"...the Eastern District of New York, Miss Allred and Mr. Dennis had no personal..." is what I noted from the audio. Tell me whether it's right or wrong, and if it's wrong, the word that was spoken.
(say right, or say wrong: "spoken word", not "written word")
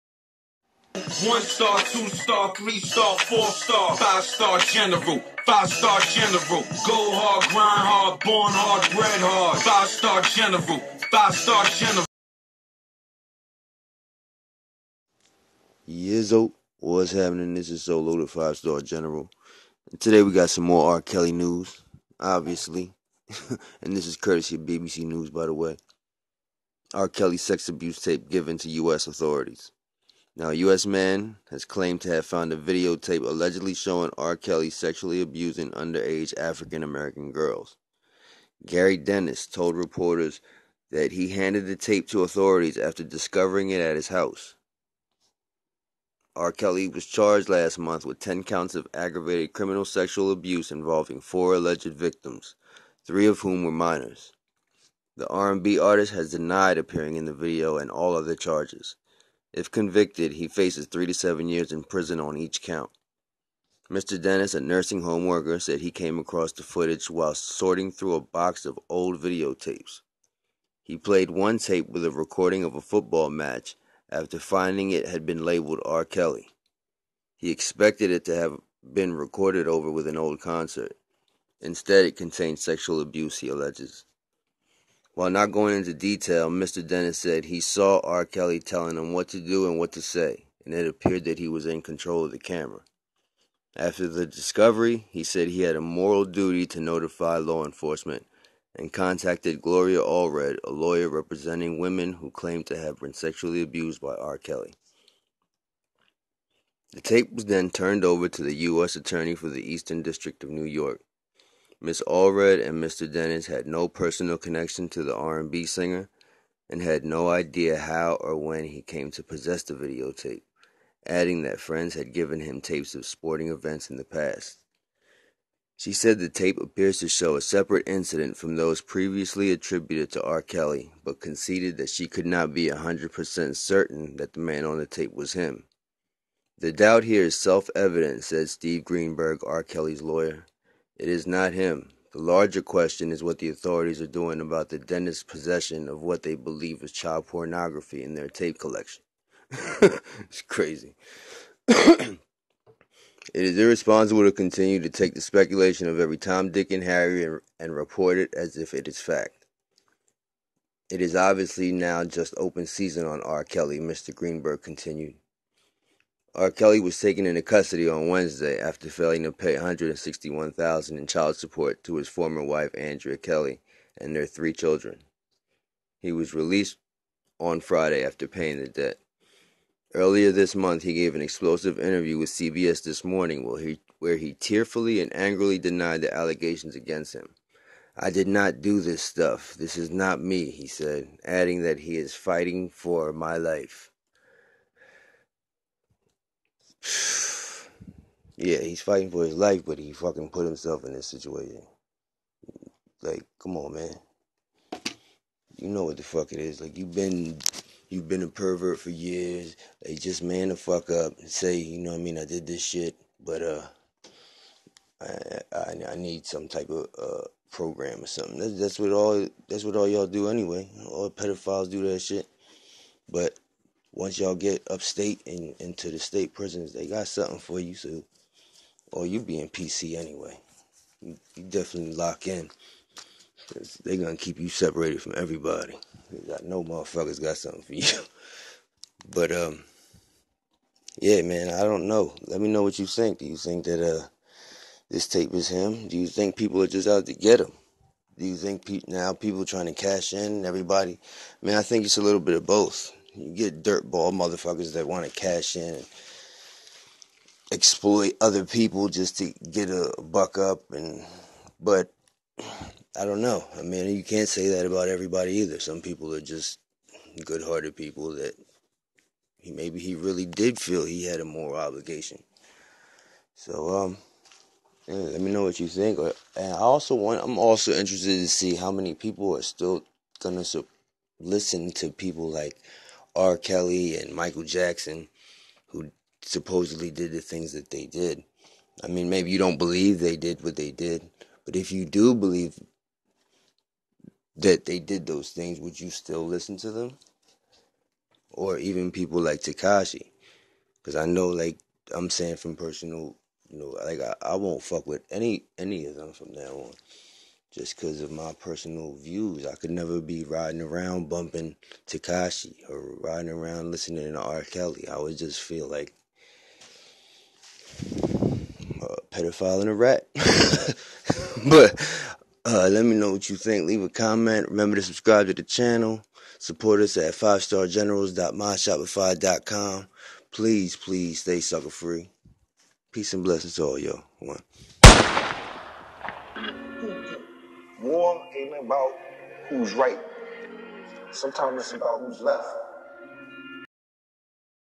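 right.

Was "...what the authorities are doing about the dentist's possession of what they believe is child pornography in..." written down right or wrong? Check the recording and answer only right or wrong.
right.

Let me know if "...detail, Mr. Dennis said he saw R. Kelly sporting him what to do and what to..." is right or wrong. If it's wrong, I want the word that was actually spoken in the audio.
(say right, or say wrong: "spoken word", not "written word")
wrong: "telling", not "sporting".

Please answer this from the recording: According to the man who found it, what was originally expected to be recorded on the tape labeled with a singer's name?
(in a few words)
A football match.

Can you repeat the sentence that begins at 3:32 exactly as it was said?
I did this shit, but uh, I I, I need some type of uh program or something.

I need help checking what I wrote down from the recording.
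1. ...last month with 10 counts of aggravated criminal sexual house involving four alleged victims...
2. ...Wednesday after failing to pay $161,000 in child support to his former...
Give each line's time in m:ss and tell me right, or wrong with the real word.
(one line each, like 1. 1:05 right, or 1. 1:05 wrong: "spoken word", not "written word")
1. 0:47 wrong: "abuse", not "house"
2. 2:48 right.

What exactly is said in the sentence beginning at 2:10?
Kelly, but conceded that she could not be 100% certain that the man on the tape was him.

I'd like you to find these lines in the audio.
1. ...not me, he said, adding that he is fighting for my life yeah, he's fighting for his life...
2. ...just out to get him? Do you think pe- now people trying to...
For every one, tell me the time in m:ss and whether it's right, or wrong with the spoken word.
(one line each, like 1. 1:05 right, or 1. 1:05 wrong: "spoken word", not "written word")
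1. 3:09 right
2. 4:06 right.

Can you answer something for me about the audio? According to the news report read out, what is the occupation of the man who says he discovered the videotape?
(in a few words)
Nursing home worker.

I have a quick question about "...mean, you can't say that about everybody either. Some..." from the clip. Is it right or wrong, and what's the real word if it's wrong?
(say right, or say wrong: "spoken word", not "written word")
right.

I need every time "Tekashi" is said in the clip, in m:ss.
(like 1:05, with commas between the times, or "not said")
4:59, 5:11.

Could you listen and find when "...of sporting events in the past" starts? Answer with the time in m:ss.
2:02.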